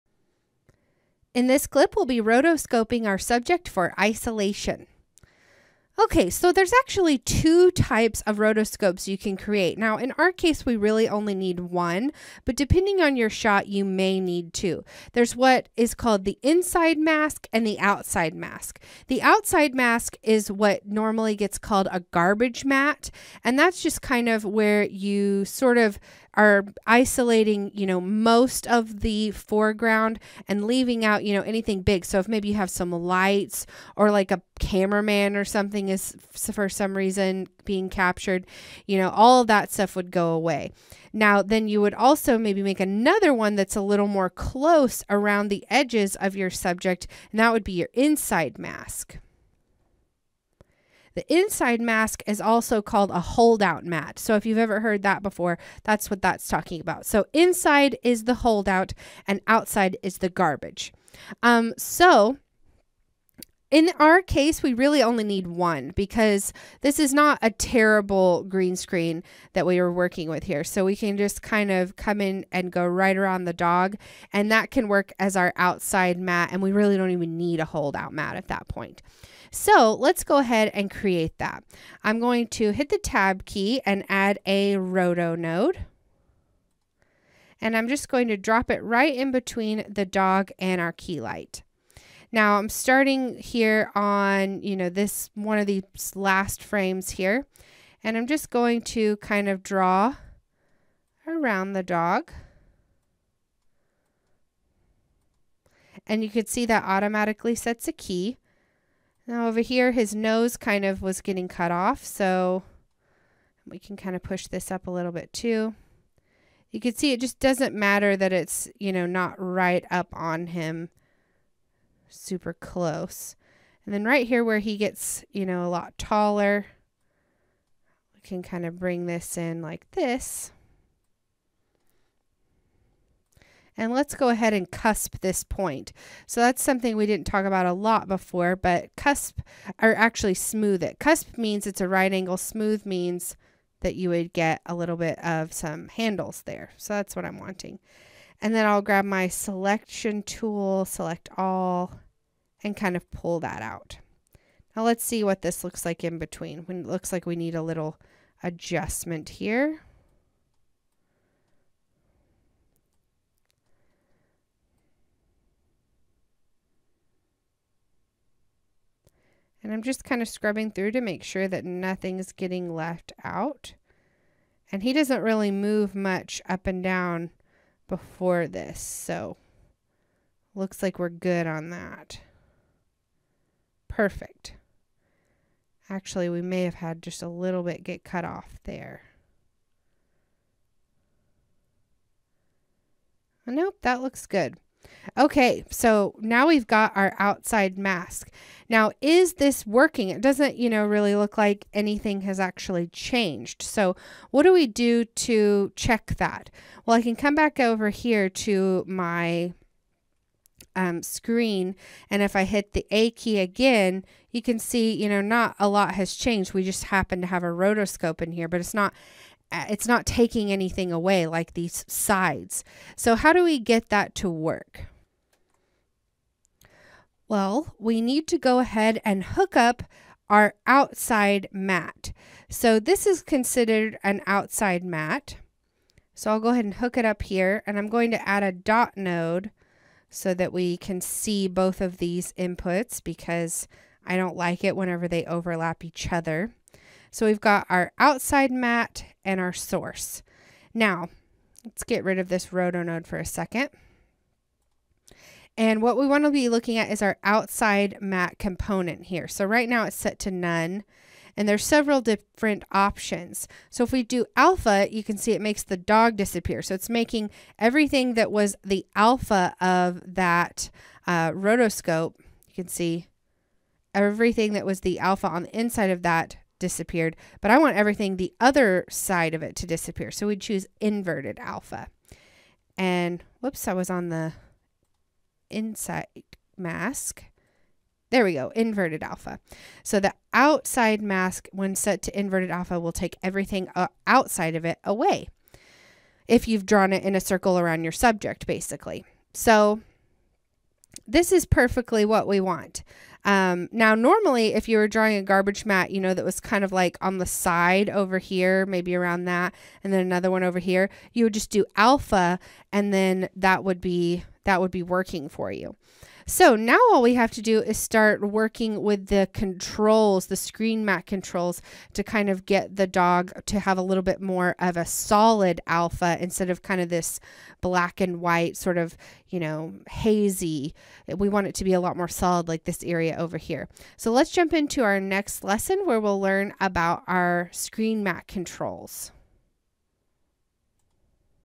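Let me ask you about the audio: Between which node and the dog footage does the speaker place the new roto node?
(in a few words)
Keylight.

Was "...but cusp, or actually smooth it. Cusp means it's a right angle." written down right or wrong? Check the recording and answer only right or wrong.
right.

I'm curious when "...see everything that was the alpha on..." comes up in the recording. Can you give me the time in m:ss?
4:32.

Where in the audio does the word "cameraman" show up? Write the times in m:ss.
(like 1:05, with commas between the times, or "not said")
0:34.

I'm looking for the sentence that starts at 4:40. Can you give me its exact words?
So we would choose inverted alpha.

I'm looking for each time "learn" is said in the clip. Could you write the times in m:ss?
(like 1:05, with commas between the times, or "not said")
5:36.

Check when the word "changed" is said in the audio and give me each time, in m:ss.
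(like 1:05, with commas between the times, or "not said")
3:22, 3:36.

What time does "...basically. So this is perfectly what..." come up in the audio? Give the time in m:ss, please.
4:58.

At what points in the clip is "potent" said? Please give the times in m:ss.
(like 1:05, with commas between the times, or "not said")
not said.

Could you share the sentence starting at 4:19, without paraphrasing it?
So right now it's set to none.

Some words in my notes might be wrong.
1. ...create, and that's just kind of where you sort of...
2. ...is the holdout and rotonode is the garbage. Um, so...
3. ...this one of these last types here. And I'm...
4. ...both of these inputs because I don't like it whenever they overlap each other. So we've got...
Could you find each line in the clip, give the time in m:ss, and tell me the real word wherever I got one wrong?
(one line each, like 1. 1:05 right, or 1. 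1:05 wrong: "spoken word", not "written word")
1. 0:22 wrong: "matte", not "create"
2. 0:58 wrong: "outside", not "rotonode"
3. 1:34 wrong: "frames", not "types"
4. 4:01 right.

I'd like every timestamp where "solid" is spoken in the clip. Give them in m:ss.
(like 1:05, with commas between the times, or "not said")
5:24, 5:32.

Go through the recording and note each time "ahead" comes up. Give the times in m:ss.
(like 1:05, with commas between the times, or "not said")
1:20, 2:14, 3:48, 3:56.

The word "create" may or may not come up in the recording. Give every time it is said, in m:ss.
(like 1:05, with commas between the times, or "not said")
0:09, 1:20.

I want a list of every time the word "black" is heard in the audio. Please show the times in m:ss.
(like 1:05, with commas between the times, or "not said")
5:27.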